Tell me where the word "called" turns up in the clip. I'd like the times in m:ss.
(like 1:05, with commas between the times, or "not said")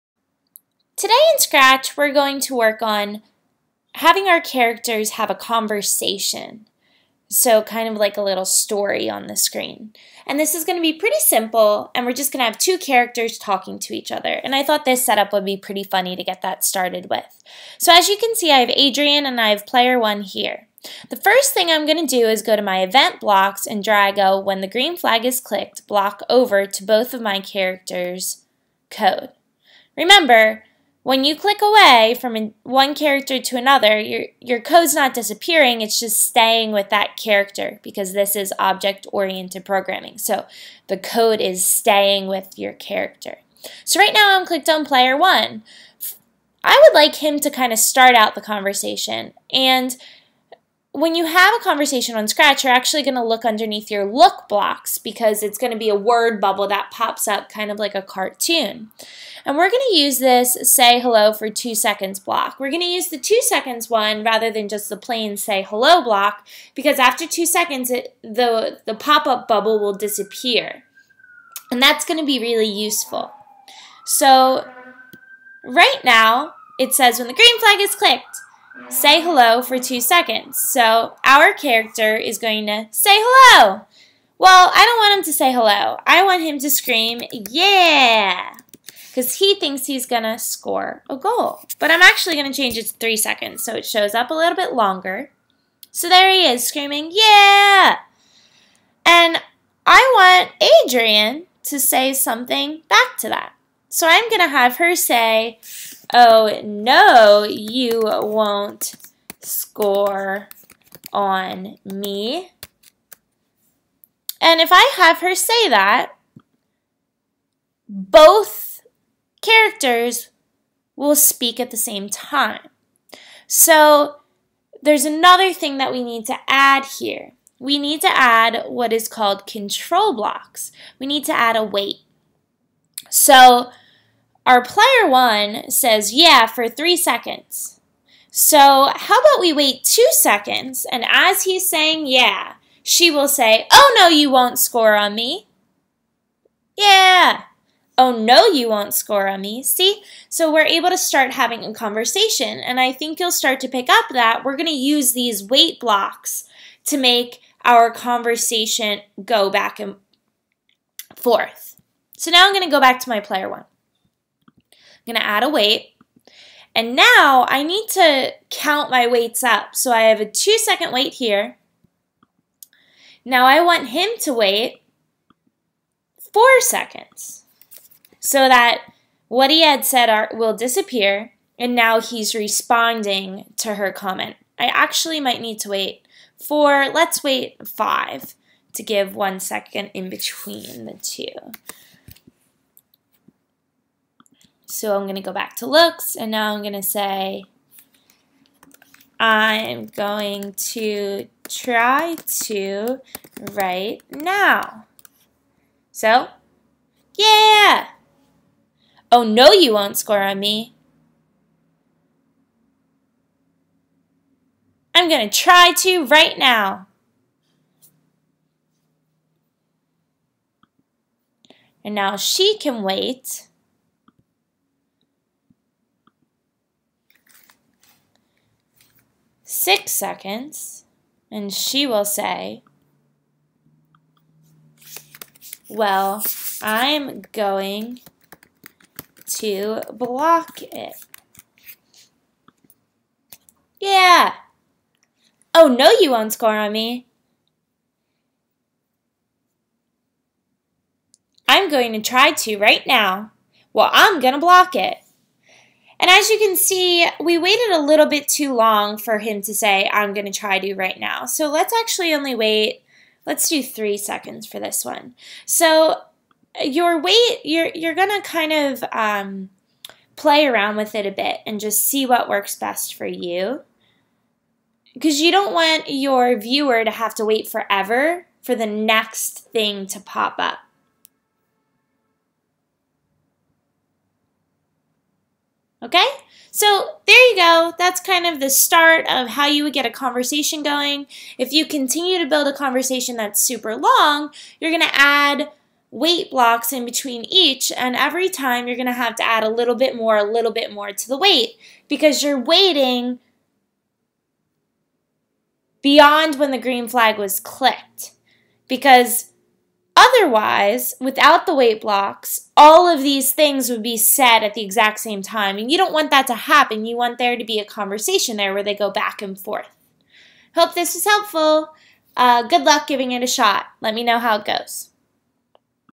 2:09.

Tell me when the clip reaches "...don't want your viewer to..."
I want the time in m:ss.
4:35.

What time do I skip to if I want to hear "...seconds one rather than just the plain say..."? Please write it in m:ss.
1:03.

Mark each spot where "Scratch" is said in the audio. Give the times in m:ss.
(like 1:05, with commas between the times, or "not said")
0:01, 0:52.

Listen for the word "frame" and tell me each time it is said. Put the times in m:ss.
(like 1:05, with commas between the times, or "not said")
not said.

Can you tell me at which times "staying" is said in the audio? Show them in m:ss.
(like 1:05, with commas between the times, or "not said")
0:36, 0:41.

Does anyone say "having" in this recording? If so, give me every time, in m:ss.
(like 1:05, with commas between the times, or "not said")
0:03, 2:31.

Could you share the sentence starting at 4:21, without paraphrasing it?
So let's actually only wait, let's do three seconds for this one.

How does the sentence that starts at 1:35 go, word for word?
So there he is screaming, yeah.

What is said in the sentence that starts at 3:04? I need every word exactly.
I actually might need to wait four, let's wait five to give one second in between the two.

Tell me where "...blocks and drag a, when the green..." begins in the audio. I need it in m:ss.
0:23.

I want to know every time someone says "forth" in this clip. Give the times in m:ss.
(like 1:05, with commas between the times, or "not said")
2:41, 5:19.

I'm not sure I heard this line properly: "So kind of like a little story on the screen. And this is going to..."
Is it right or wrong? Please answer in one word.
right.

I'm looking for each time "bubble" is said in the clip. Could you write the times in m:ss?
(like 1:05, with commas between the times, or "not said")
0:56, 1:09.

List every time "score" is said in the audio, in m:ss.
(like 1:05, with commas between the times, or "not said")
1:30, 1:49, 2:24, 2:28, 3:29, 4:06.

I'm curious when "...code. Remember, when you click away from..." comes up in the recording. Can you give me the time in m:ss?
0:28.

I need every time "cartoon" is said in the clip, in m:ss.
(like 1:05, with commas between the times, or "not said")
0:58.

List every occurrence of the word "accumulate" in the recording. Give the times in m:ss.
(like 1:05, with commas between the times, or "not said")
not said.